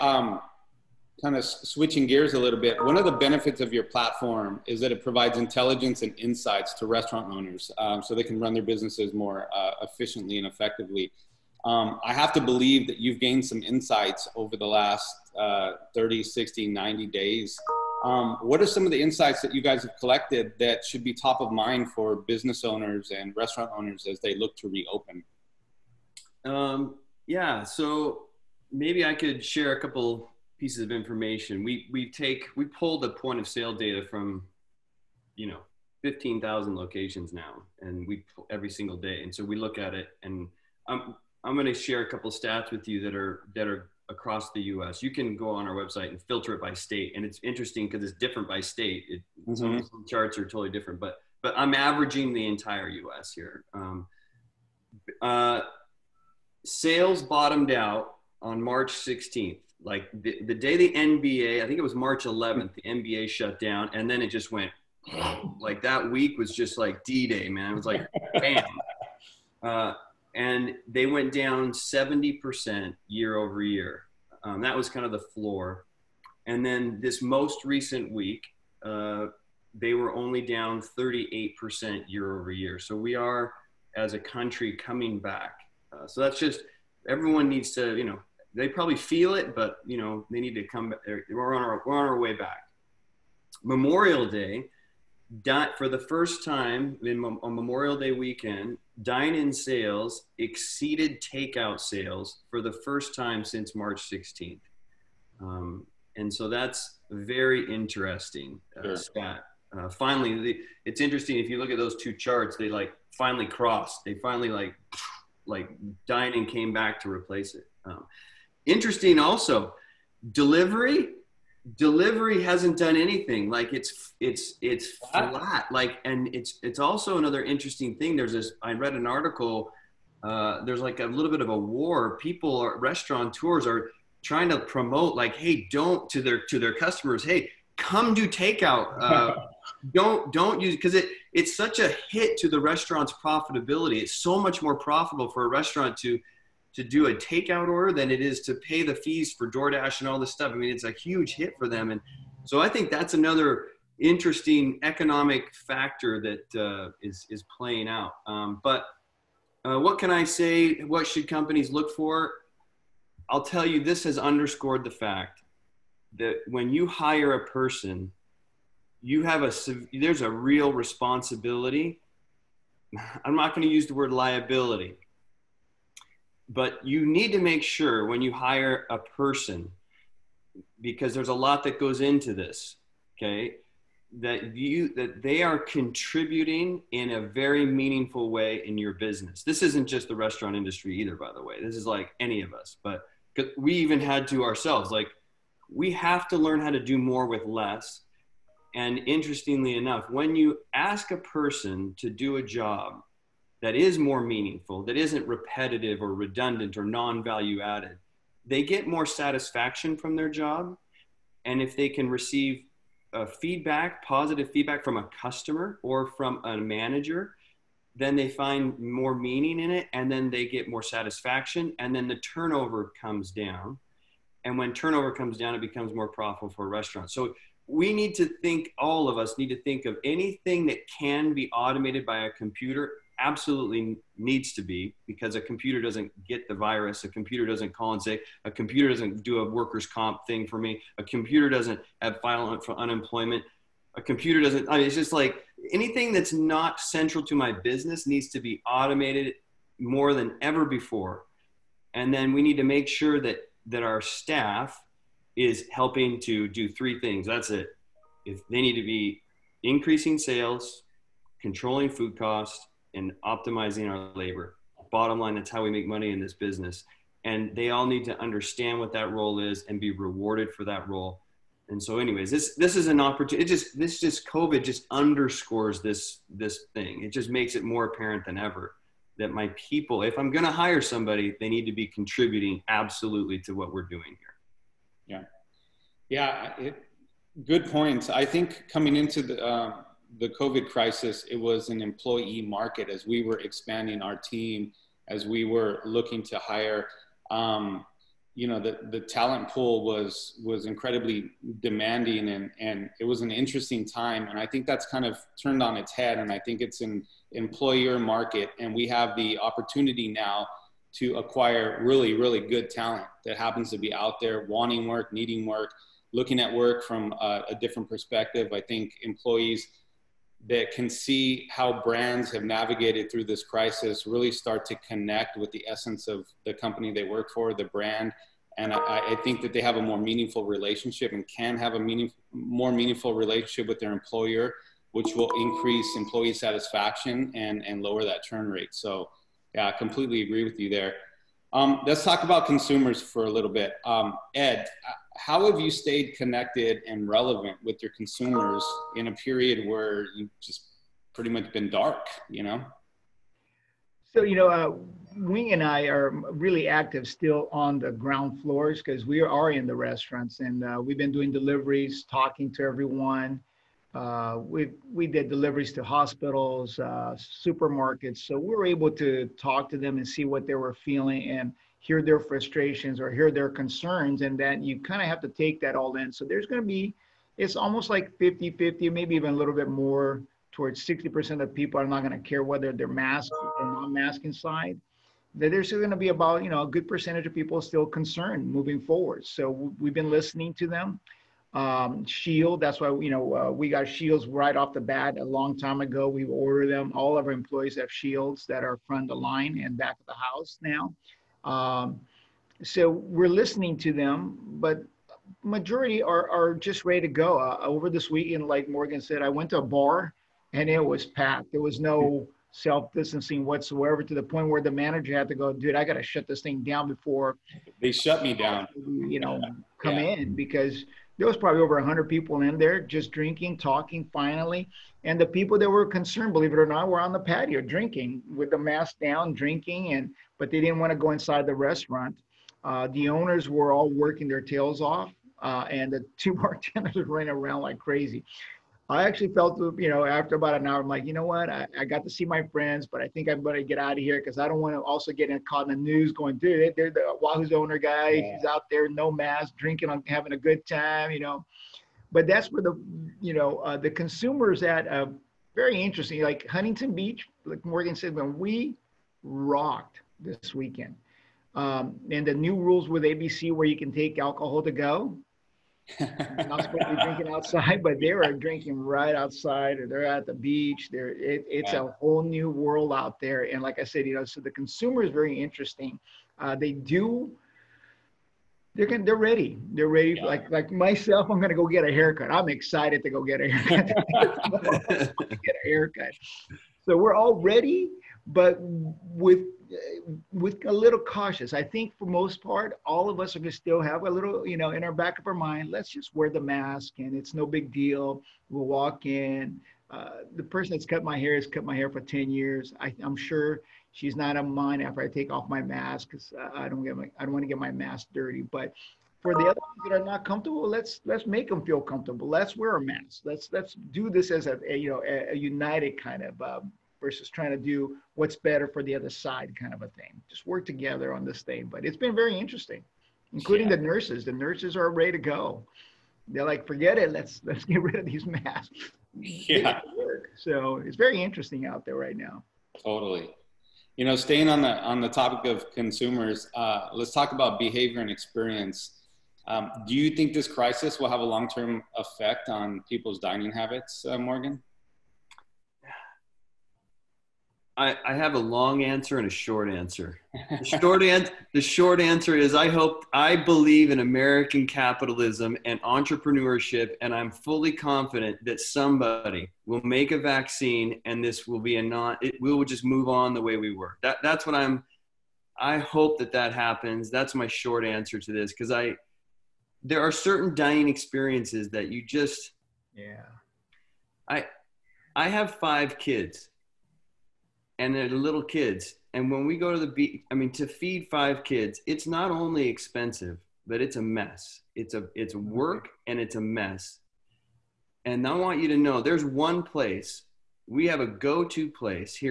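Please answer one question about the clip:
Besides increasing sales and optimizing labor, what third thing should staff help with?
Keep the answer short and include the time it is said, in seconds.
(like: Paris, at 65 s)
controlling food costs, at 261 s.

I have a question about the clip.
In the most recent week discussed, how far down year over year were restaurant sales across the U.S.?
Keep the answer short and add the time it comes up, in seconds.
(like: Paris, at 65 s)
38%, at 80 s.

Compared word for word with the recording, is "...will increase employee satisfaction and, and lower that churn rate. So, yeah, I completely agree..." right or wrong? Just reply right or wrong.
right.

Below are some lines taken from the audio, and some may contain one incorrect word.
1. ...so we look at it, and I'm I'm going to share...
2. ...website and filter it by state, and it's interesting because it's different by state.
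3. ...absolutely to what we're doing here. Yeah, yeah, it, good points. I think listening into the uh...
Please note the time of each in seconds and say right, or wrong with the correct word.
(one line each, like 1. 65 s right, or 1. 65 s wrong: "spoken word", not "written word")
1. 39 s right
2. 45 s right
3. 282 s wrong: "coming", not "listening".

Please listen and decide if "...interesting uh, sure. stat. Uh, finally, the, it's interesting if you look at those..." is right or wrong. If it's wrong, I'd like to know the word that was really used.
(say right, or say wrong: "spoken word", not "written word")
right.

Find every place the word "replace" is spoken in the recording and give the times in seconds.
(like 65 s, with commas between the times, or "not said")
117 s.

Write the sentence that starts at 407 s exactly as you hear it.
Uh, over this weekend, like Morgan said, I went to a bar and it was packed.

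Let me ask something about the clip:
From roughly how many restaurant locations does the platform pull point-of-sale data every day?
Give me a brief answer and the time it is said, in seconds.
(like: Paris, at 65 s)
15,000, at 36 s.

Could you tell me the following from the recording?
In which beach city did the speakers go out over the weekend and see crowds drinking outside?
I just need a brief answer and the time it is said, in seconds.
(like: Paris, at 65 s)
Huntington Beach, at 456 s.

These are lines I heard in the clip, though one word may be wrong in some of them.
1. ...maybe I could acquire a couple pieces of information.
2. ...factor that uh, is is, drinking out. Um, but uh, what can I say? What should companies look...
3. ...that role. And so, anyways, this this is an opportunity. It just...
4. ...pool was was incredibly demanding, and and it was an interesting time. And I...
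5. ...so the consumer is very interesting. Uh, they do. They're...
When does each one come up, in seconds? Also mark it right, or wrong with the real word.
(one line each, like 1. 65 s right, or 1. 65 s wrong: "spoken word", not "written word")
1. 28 s wrong: "share", not "acquire"
2. 155 s wrong: "playing", not "drinking"
3. 270 s right
4. 299 s right
5. 474 s right.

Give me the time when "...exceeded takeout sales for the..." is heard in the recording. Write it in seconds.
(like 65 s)
100 s.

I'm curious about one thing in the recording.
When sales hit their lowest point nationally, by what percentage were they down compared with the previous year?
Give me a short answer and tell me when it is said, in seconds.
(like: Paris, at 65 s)
70%, at 71 s.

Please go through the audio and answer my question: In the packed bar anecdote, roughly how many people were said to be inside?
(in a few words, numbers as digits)
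over 100.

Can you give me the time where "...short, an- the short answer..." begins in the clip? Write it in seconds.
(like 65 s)
550 s.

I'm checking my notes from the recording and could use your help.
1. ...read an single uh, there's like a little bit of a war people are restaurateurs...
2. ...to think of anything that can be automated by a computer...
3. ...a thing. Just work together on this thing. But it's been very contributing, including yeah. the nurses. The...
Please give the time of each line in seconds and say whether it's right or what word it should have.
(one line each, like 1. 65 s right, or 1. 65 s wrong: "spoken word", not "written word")
1. 128 s wrong: "article", not "single"
2. 229 s right
3. 519 s wrong: "interesting", not "contributing".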